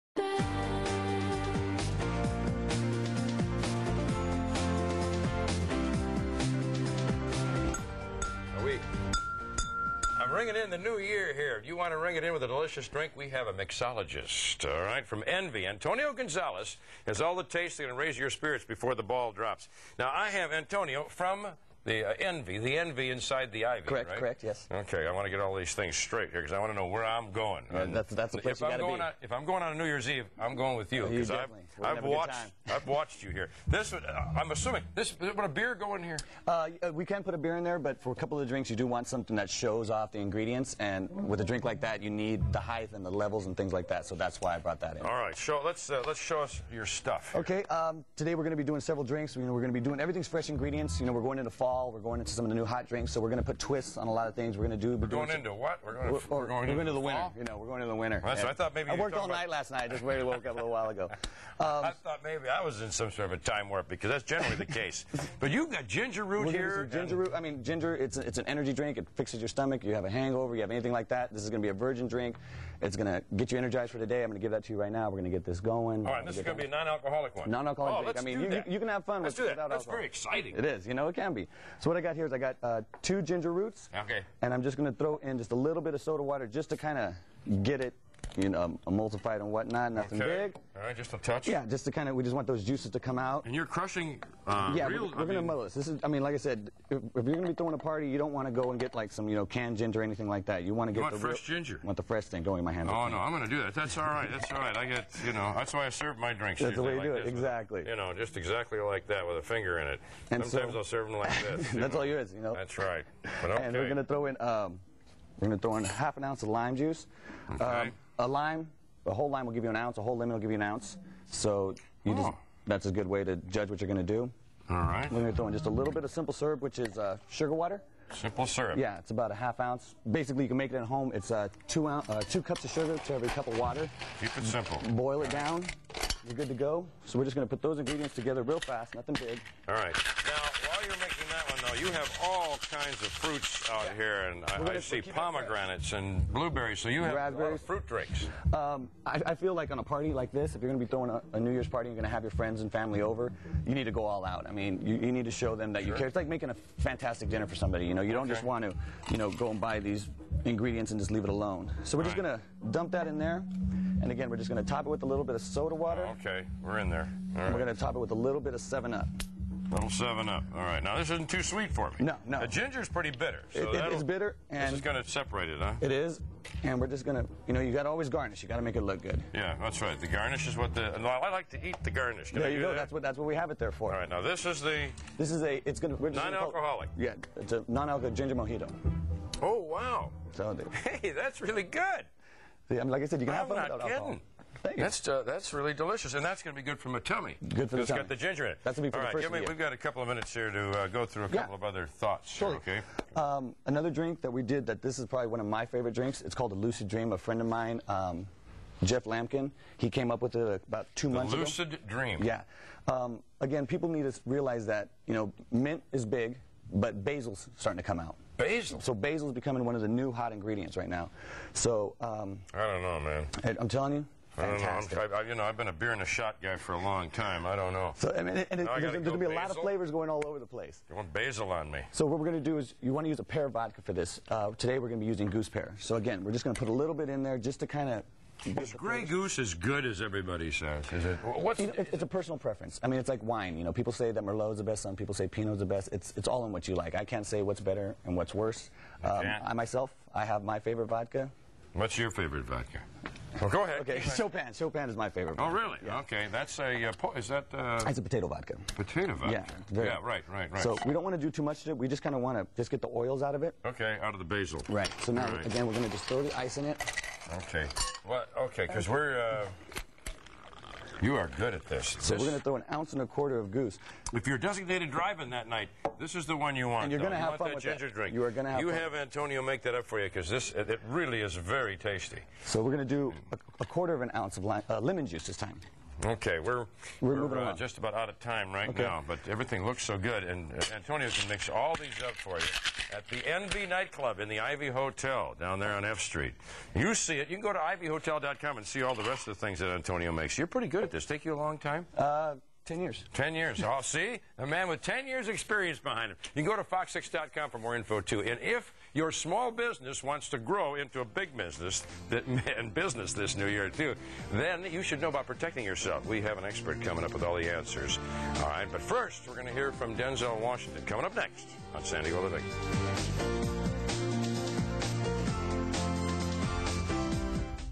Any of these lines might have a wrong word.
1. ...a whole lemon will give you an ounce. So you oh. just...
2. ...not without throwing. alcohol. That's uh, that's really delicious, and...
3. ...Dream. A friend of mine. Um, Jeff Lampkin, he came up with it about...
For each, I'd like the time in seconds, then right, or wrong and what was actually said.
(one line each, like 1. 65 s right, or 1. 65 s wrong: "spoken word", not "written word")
1. 119 s right
2. 193 s wrong: "kidding", not "throwing"
3. 206 s right.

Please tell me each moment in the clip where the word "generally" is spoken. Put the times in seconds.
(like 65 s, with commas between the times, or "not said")
64 s.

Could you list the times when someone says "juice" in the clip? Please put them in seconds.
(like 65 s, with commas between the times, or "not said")
92 s, 116 s, 285 s.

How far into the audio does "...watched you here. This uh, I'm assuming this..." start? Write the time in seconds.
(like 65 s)
32 s.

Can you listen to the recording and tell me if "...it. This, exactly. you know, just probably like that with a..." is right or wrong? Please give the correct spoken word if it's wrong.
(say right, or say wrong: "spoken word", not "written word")
wrong: "exactly", not "probably".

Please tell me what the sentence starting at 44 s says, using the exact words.
So that's why I brought that in.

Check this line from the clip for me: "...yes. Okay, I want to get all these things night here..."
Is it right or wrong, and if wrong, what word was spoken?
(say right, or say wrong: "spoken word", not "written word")
wrong: "straight", not "night".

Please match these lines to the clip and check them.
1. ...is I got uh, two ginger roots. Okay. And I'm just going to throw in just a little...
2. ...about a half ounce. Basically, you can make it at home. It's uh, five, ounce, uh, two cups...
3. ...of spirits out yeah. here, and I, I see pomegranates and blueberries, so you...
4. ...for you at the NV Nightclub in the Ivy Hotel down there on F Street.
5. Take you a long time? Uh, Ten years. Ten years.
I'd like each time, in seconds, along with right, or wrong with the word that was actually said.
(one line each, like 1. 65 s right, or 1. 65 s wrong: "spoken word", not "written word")
1. 82 s right
2. 129 s wrong: "two", not "five"
3. 143 s wrong: "fruits", not "spirits"
4. 292 s right
5. 301 s right.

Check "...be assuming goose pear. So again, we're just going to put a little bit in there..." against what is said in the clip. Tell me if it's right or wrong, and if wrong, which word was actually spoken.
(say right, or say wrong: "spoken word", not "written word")
wrong: "using", not "assuming".